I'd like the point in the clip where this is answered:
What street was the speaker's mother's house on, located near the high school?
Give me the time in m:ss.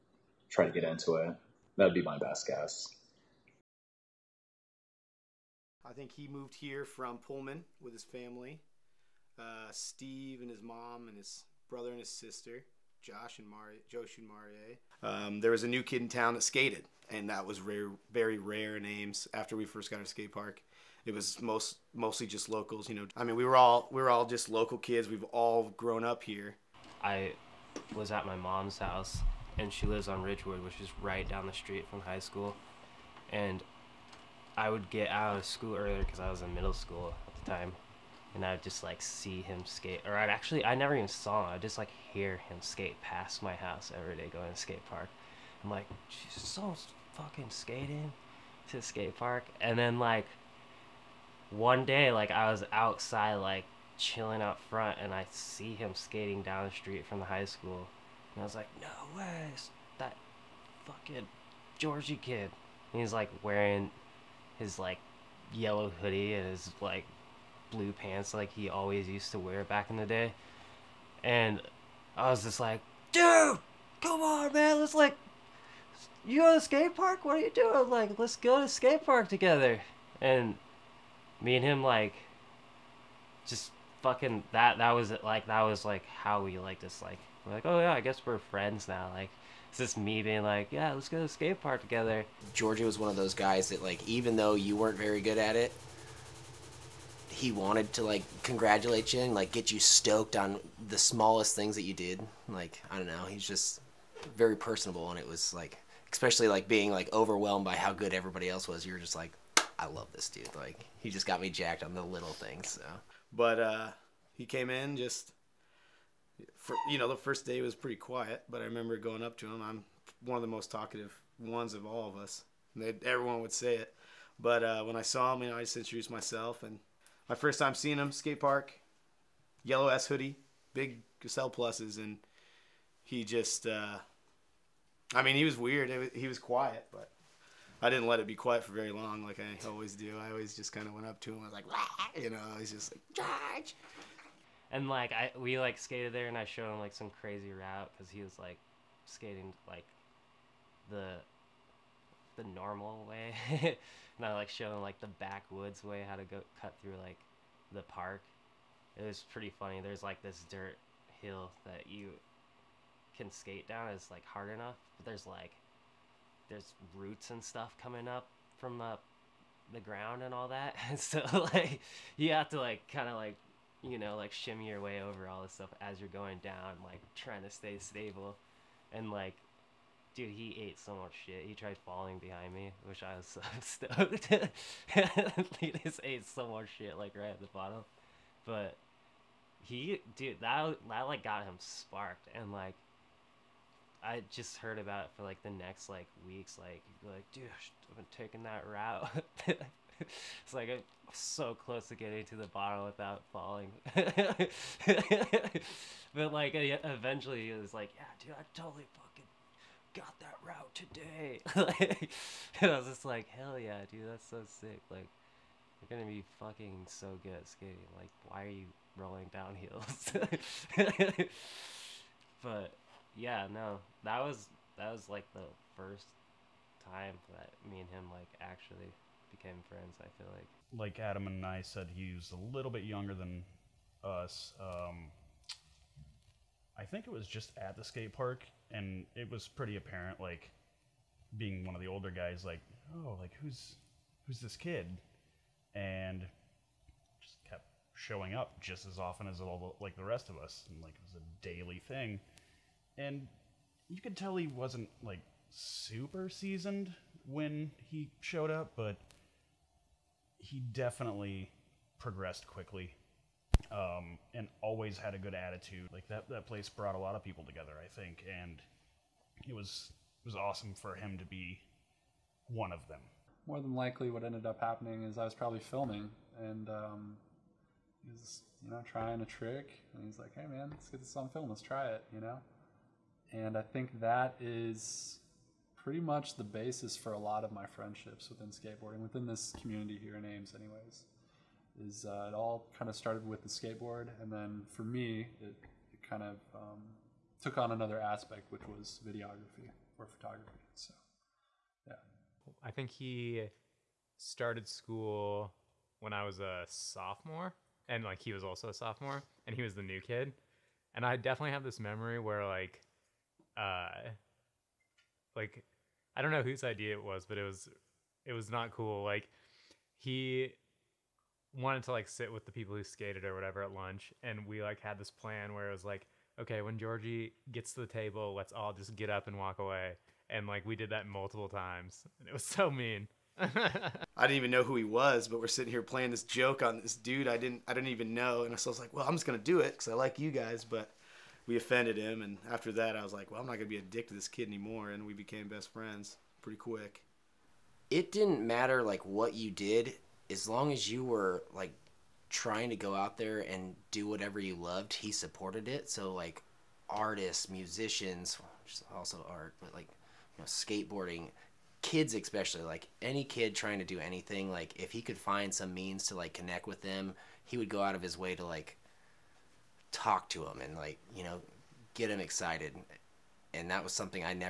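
0:30.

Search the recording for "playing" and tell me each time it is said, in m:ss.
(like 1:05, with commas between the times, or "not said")
5:35.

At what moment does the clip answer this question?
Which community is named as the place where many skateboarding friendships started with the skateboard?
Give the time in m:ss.
4:50.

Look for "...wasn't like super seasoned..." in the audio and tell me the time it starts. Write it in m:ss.
4:14.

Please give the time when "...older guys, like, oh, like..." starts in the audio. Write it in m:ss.
4:01.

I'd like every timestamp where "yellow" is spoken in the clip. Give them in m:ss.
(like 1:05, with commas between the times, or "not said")
1:05, 2:09.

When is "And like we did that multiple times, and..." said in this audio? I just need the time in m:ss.
5:30.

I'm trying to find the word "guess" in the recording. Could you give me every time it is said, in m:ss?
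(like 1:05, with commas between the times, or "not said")
0:02, 1:28.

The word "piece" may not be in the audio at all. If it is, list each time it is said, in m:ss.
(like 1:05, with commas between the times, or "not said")
not said.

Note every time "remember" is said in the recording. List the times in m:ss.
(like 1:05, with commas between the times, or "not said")
1:58.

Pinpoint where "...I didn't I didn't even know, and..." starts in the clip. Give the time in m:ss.
5:37.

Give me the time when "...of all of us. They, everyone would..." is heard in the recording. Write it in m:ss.
2:01.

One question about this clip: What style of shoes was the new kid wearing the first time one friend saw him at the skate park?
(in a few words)
Gazelle pluses.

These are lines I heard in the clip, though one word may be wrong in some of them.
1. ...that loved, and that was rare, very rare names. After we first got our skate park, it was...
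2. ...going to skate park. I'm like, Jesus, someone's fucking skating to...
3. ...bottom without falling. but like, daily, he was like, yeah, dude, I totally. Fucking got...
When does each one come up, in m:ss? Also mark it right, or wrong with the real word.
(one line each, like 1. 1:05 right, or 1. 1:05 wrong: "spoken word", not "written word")
1. 0:16 wrong: "skated", not "loved"
2. 0:44 right
3. 3:22 wrong: "eventually", not "daily".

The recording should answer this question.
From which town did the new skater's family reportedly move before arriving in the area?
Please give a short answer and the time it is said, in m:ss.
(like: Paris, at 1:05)
Pullman, at 0:07.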